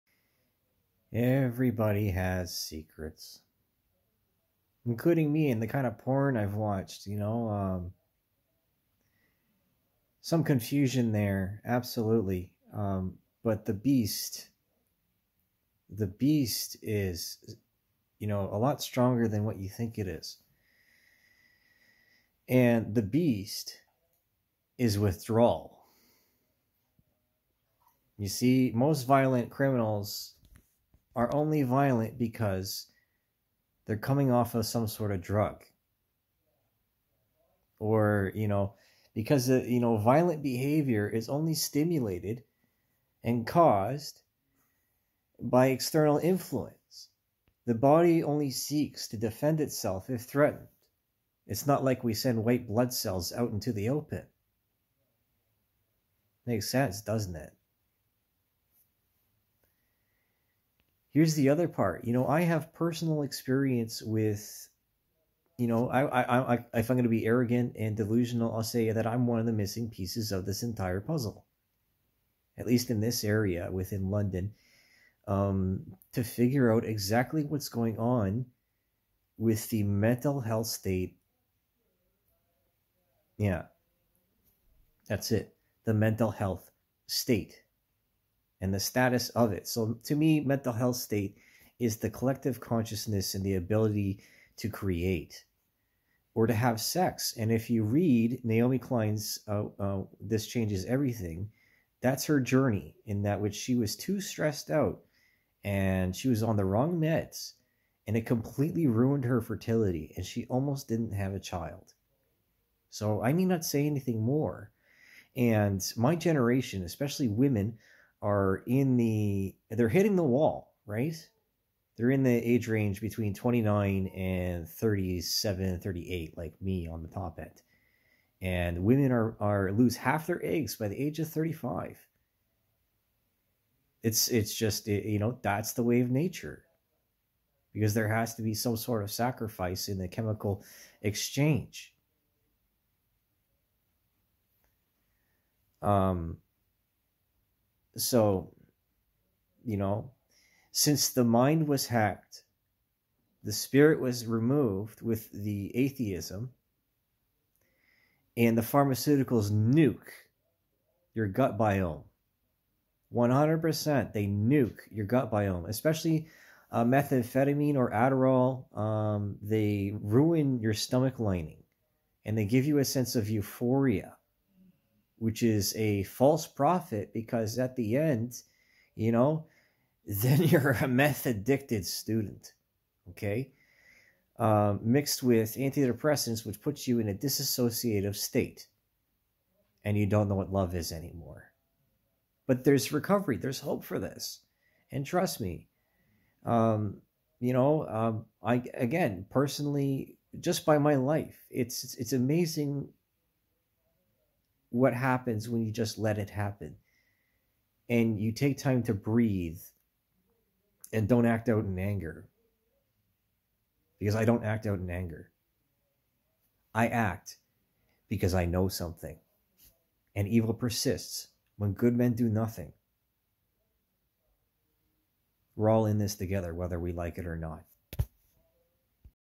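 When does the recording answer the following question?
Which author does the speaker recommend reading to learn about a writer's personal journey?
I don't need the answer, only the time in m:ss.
1:38.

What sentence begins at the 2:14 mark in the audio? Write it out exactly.
It's it's just it, you know, that's the way of nature.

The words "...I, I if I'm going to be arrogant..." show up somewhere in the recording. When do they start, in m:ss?
1:06.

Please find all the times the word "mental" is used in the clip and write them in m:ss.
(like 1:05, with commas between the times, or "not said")
1:19, 1:25, 1:30.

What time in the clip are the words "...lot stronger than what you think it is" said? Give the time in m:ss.
0:18.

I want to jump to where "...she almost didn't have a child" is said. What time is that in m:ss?
1:50.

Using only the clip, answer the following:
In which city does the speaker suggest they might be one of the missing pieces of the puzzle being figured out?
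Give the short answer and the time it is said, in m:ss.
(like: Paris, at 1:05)
London, at 1:14.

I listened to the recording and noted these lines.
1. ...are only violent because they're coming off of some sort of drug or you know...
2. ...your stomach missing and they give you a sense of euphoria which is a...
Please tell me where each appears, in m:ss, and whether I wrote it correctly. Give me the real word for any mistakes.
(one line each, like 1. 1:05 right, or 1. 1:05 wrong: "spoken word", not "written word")
1. 0:31 right
2. 2:50 wrong: "lining", not "missing".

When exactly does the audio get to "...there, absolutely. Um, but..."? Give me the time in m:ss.
0:11.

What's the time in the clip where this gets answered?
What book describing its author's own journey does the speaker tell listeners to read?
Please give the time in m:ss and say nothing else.
1:40.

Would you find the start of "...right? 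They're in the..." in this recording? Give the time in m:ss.
2:00.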